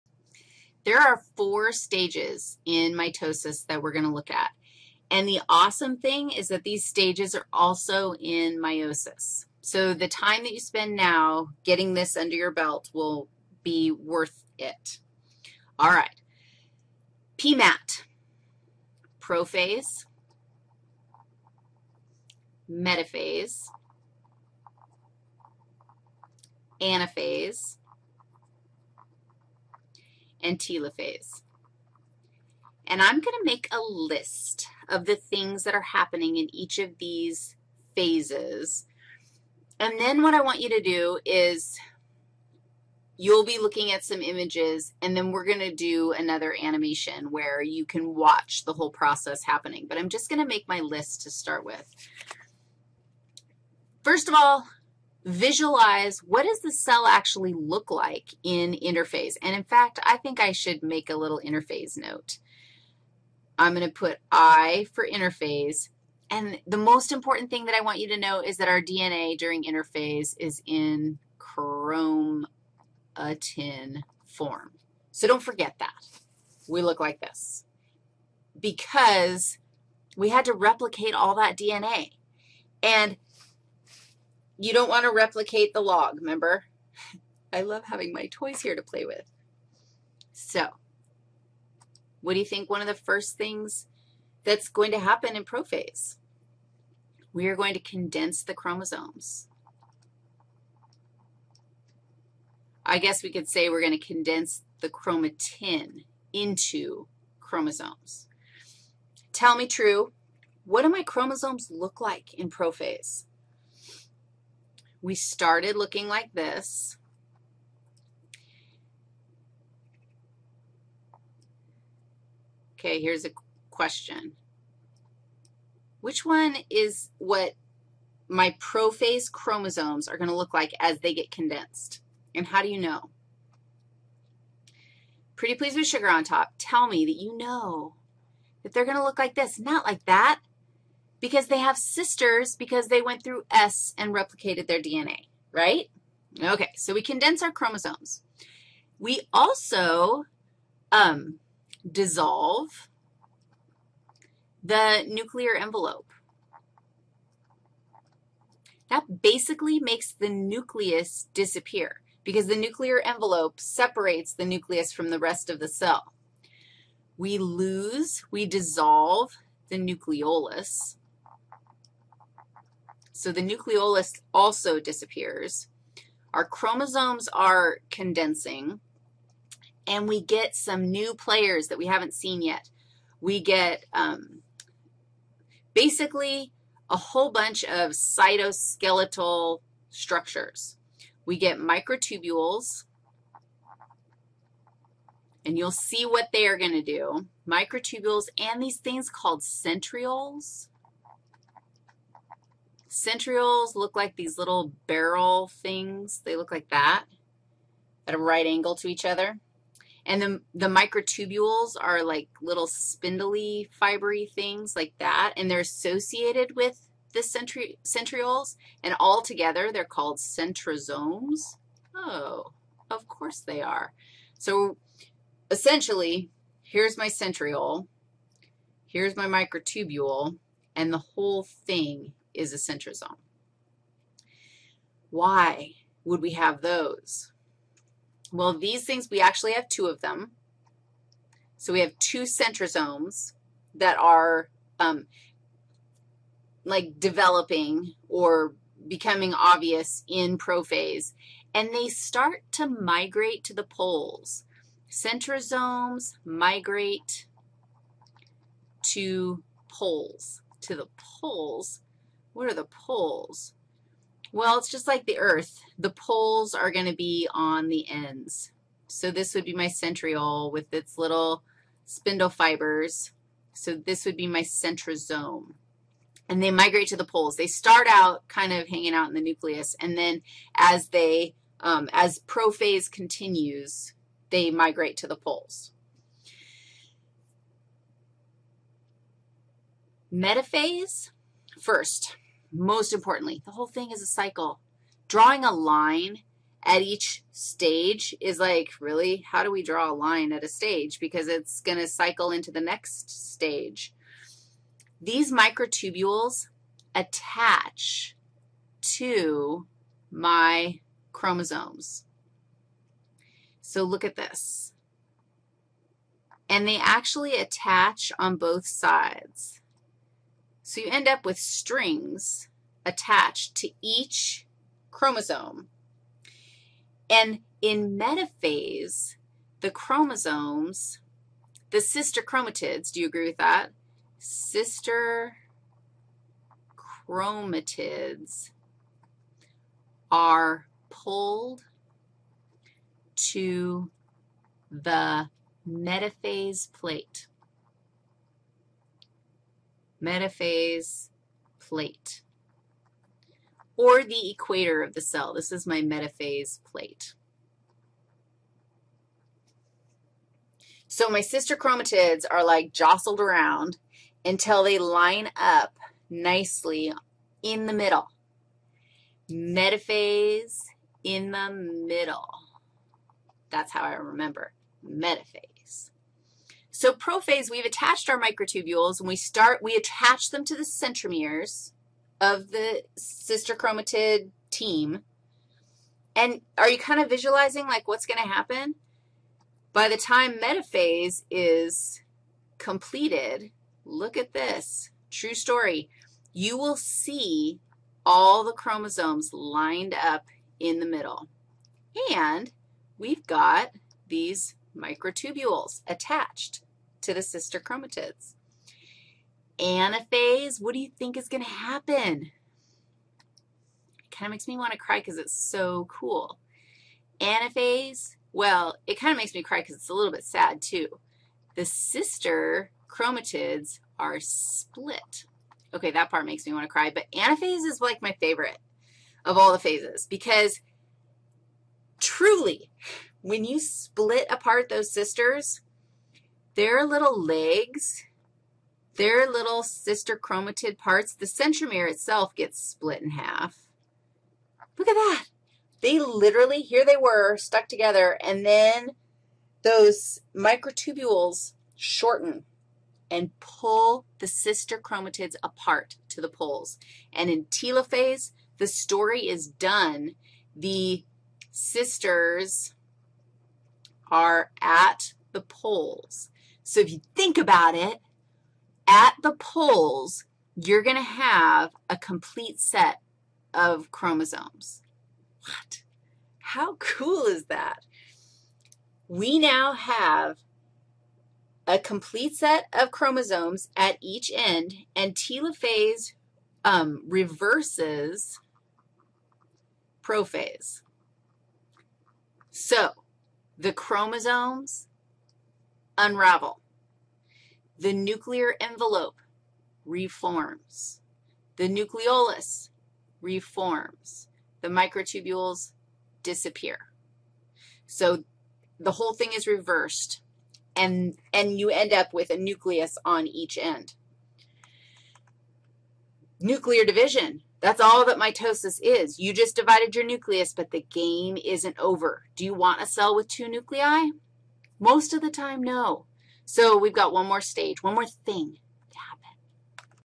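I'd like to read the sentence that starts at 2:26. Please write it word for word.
Okay, so we condense our chromosomes.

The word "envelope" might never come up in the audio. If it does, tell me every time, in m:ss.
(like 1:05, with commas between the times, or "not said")
2:35, 2:43, 8:18.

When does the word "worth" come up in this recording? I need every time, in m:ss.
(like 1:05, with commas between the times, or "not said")
0:13.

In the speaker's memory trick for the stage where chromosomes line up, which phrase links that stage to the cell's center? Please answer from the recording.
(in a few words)
Metaphase in the middle.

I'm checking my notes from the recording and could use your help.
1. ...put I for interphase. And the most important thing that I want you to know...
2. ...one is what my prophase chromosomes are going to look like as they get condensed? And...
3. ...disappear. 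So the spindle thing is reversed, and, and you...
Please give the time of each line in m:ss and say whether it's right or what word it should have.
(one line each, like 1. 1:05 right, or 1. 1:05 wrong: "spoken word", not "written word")
1. 1:03 right
2. 2:06 right
3. 8:26 wrong: "whole", not "spindle".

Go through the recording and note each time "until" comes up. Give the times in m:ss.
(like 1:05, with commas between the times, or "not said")
6:04.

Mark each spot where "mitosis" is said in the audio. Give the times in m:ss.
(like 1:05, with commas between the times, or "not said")
0:02, 8:38.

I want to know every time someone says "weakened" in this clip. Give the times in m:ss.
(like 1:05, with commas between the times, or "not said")
not said.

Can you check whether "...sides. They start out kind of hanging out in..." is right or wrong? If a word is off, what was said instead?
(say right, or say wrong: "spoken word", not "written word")
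wrong: "poles", not "sides".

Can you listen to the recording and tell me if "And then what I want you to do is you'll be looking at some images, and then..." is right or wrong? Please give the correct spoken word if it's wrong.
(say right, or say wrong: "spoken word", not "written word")
right.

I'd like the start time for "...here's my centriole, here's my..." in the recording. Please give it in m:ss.
3:46.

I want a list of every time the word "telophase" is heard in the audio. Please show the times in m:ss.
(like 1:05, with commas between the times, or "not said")
0:30, 7:37, 8:05.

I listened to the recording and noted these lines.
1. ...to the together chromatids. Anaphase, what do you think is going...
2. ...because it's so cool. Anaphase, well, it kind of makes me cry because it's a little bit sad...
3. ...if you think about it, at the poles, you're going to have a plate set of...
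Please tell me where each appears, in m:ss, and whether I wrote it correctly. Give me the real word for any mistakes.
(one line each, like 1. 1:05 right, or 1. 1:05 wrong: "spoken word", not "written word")
1. 6:47 wrong: "sister", not "together"
2. 6:54 right
3. 7:46 wrong: "complete", not "plate".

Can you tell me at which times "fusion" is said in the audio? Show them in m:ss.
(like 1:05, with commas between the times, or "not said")
not said.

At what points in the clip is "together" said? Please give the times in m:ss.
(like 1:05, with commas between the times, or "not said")
3:39, 7:27.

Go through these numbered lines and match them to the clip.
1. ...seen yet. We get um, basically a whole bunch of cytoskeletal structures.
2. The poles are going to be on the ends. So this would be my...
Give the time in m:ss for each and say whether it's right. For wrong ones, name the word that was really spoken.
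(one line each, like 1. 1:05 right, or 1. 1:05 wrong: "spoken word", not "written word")
1. 3:02 right
2. 4:25 right.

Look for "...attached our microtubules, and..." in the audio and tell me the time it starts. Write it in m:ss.
6:17.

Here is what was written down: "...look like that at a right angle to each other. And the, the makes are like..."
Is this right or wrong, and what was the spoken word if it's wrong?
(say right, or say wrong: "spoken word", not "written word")
wrong: "microtubules", not "makes".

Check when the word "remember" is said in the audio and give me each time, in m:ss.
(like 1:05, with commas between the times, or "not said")
1:26, 6:13.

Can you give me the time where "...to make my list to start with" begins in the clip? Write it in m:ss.
0:50.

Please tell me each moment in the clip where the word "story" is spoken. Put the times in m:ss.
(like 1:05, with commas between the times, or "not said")
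6:35, 7:38.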